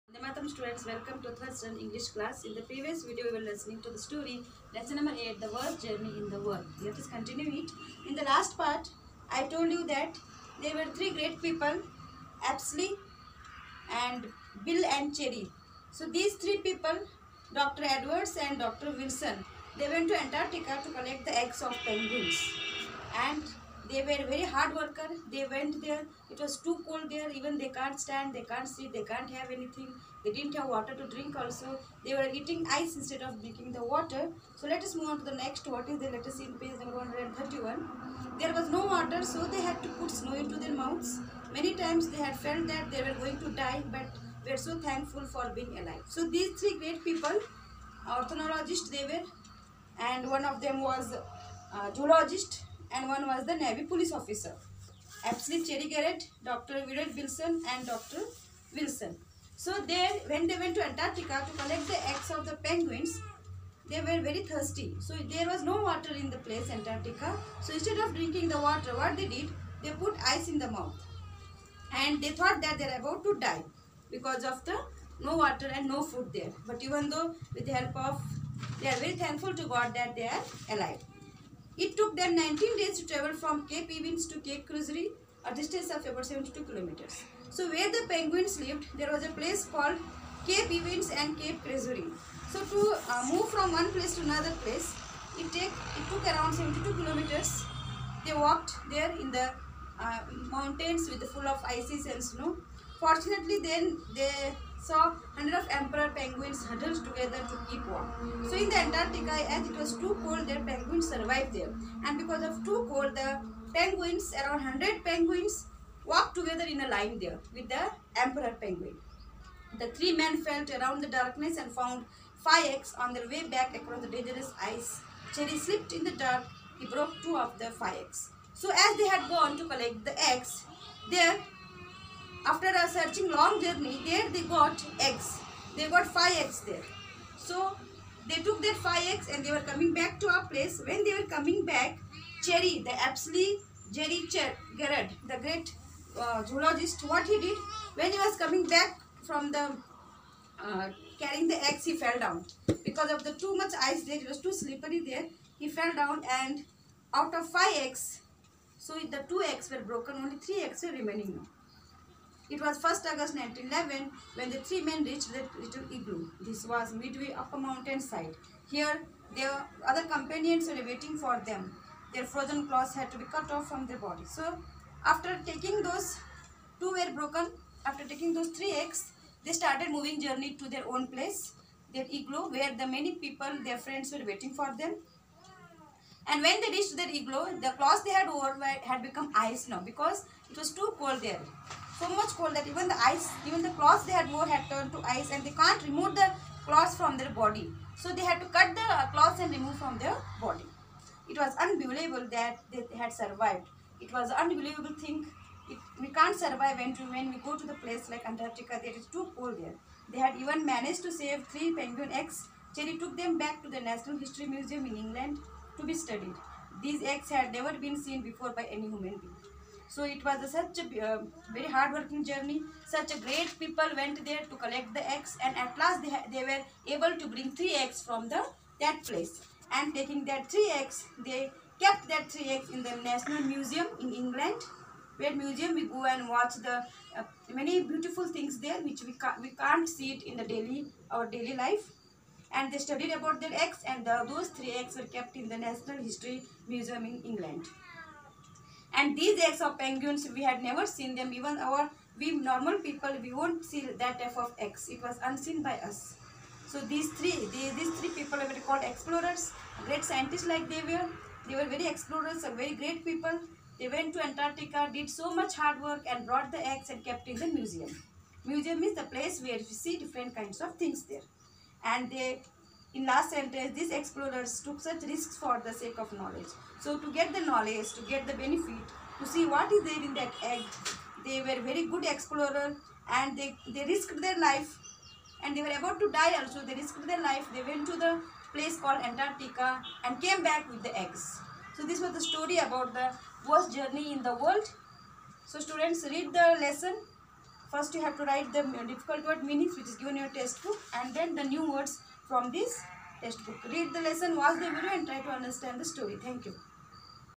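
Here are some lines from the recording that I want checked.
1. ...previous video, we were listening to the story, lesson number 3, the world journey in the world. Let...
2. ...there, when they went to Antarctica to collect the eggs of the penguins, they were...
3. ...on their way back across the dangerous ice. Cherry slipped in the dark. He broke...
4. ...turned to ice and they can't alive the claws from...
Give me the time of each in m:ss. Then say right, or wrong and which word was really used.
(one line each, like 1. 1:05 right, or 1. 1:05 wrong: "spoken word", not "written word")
1. 0:02 wrong: "8", not "3"
2. 0:59 right
3. 2:02 right
4. 3:14 wrong: "remove", not "alive".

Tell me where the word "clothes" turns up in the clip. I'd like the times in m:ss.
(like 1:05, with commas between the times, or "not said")
3:07.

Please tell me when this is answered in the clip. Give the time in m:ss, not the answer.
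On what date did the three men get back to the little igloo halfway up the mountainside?
2:42.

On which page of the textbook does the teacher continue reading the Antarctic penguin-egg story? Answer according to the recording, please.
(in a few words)
131.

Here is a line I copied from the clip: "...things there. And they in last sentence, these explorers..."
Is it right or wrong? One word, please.
right.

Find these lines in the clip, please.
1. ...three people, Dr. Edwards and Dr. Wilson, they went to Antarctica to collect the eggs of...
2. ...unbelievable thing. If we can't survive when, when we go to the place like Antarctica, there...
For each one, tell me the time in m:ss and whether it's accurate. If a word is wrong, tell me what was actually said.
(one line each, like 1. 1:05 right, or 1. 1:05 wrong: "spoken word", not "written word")
1. 0:16 right
2. 3:24 right.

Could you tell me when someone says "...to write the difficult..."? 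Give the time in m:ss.
4:58.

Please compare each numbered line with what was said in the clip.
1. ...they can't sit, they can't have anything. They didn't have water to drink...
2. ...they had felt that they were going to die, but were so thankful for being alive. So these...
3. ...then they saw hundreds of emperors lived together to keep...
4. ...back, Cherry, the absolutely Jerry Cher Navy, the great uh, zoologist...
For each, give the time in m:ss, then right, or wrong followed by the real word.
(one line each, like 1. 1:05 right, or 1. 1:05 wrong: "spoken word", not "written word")
1. 0:28 right
2. 0:42 right
3. 1:43 wrong: "huddled", not "lived"
4. 2:21 wrong: "Garrett", not "Navy".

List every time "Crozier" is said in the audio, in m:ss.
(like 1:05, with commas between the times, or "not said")
1:24, 1:31.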